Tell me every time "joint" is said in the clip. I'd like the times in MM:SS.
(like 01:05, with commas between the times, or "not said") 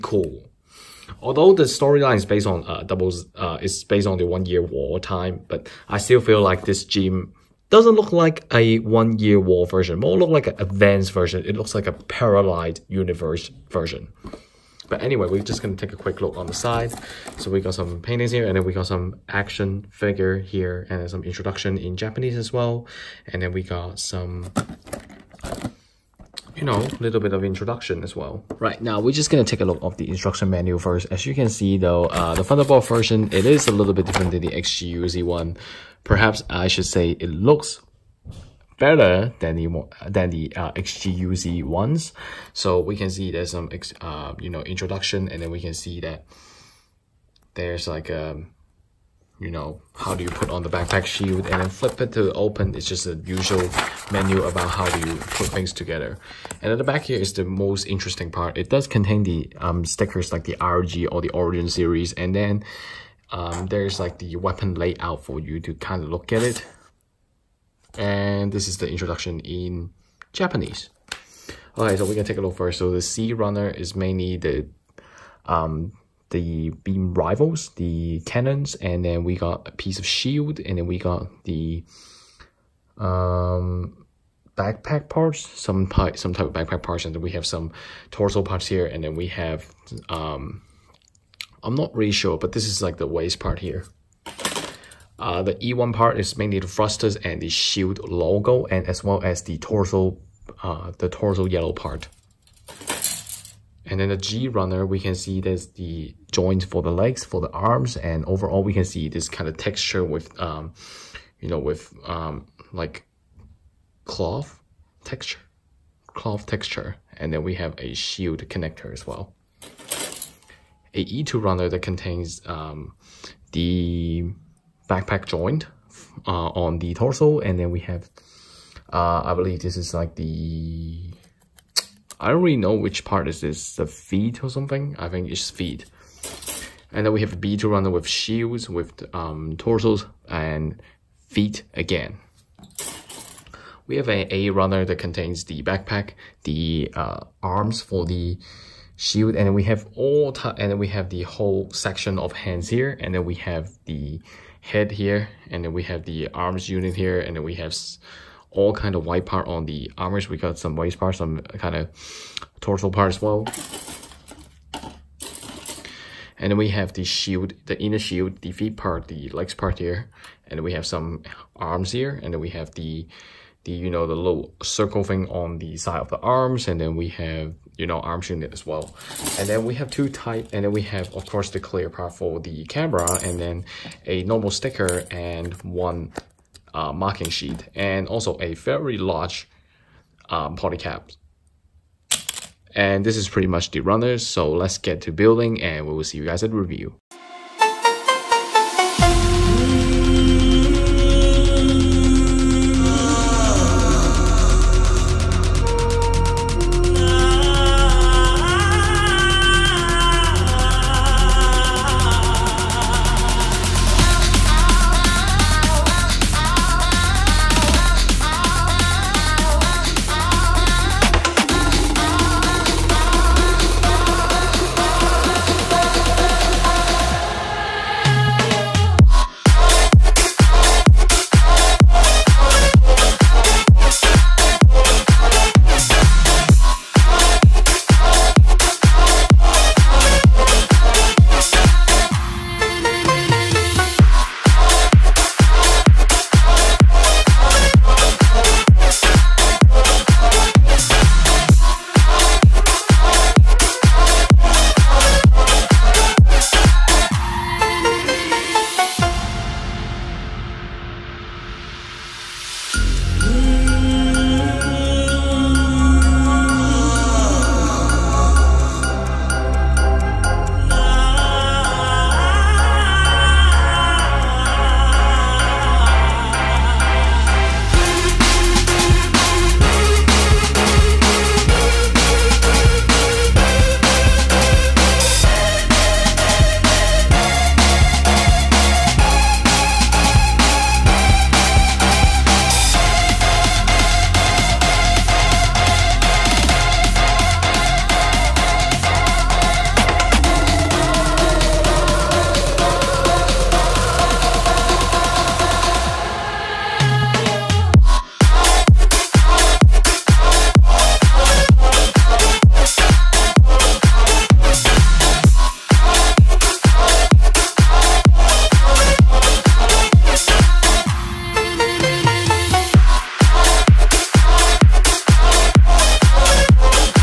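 01:46, 02:05.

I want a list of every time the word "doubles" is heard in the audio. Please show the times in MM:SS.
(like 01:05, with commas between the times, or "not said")
00:02.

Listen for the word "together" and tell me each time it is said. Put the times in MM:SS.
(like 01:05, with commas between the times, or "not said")
00:55.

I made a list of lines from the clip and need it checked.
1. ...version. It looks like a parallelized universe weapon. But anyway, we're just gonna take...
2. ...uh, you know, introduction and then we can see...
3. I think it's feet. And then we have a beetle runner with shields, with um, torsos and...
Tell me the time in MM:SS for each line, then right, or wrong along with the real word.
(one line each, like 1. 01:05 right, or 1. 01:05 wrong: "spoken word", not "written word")
1. 00:11 wrong: "version", not "weapon"
2. 00:44 right
3. 02:14 right.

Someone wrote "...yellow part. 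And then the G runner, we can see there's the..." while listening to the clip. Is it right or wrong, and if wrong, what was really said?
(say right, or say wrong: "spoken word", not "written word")
right.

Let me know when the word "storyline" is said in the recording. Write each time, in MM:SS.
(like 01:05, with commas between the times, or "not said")
00:01.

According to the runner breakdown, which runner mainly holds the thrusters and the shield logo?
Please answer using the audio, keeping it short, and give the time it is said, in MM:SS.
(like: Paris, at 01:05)
E1, at 01:35.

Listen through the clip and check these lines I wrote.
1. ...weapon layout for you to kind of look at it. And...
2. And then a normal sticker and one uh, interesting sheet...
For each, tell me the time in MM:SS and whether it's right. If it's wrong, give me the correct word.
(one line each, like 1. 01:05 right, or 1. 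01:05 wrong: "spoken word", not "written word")
1. 01:04 right
2. 03:03 wrong: "marking", not "interesting".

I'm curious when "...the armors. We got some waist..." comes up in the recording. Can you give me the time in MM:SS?
02:39.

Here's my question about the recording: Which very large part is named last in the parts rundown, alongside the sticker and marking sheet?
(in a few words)
Polycap.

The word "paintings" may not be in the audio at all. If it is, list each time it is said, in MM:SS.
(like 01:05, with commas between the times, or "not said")
00:18.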